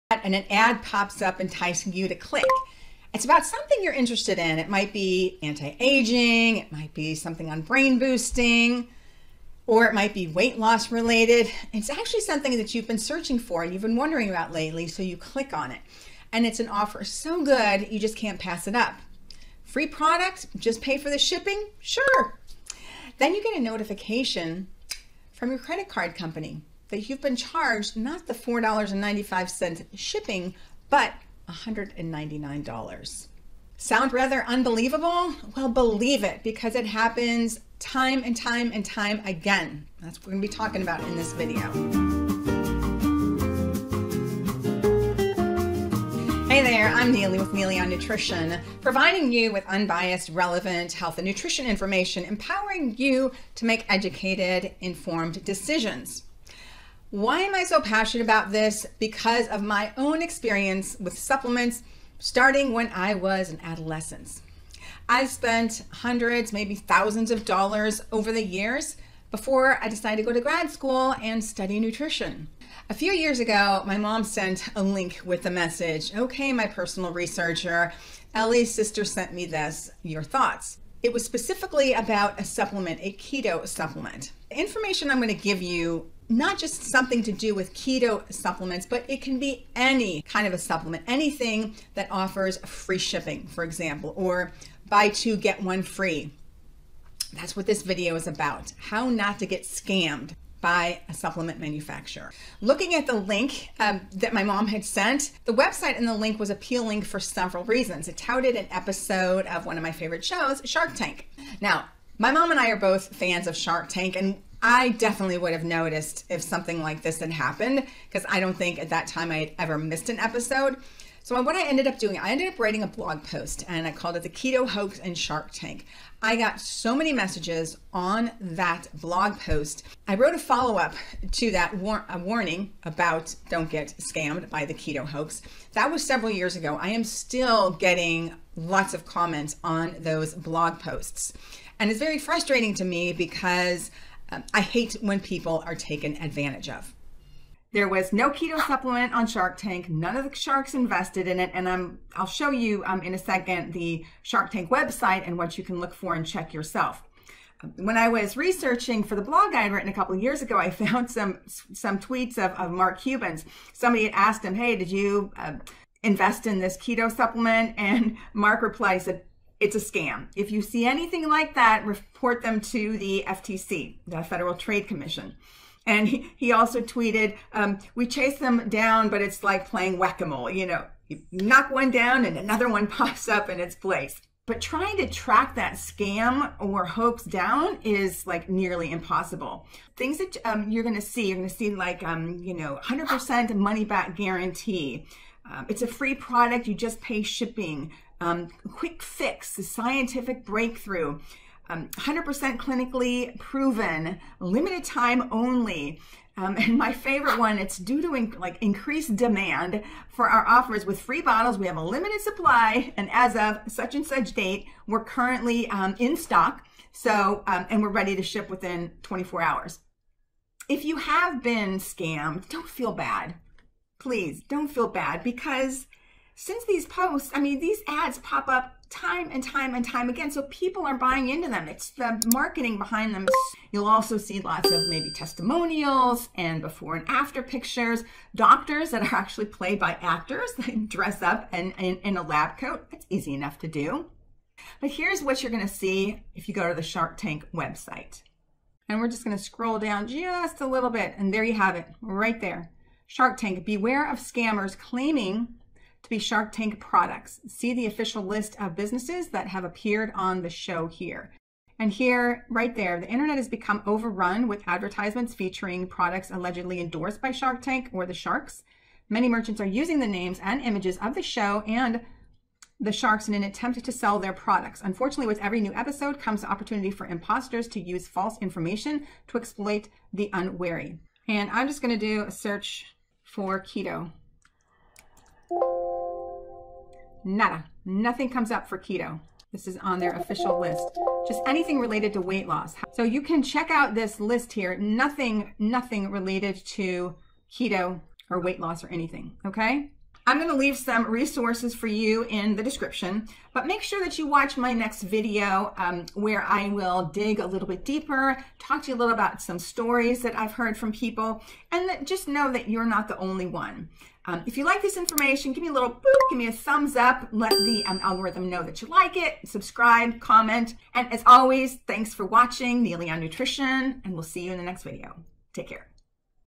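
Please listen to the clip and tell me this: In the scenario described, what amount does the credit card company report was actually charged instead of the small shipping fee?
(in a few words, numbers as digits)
$199.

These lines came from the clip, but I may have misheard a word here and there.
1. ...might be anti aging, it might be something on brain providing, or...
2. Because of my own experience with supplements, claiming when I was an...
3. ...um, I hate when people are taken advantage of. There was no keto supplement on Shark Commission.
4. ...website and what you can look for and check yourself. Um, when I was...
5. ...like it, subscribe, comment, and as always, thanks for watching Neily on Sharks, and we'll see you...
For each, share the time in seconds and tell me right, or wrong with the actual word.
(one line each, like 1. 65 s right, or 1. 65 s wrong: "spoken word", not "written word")
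1. 4 s wrong: "boosting", not "providing"
2. 58 s wrong: "starting", not "claiming"
3. 144 s wrong: "Tank", not "Commission"
4. 154 s right
5. 318 s wrong: "Nutrition", not "Sharks".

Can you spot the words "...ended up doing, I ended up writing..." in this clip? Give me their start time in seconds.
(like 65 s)
121 s.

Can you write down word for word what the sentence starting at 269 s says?
Many merchants are using the names and images of the show and the sharks in an attempt to sell their products.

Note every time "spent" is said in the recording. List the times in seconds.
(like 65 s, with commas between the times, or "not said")
65 s.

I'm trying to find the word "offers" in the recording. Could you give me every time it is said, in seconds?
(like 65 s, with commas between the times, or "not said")
16 s, 92 s, 210 s.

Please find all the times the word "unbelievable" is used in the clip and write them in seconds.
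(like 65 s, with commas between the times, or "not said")
34 s.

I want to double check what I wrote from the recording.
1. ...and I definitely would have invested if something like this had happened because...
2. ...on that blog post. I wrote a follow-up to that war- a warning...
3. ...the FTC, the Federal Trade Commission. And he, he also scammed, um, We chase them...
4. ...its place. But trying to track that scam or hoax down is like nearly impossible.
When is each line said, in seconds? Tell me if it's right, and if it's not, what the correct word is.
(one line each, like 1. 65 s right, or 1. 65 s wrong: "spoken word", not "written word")
1. 114 s wrong: "noticed", not "invested"
2. 127 s right
3. 172 s wrong: "tweeted", not "scammed"
4. 183 s right.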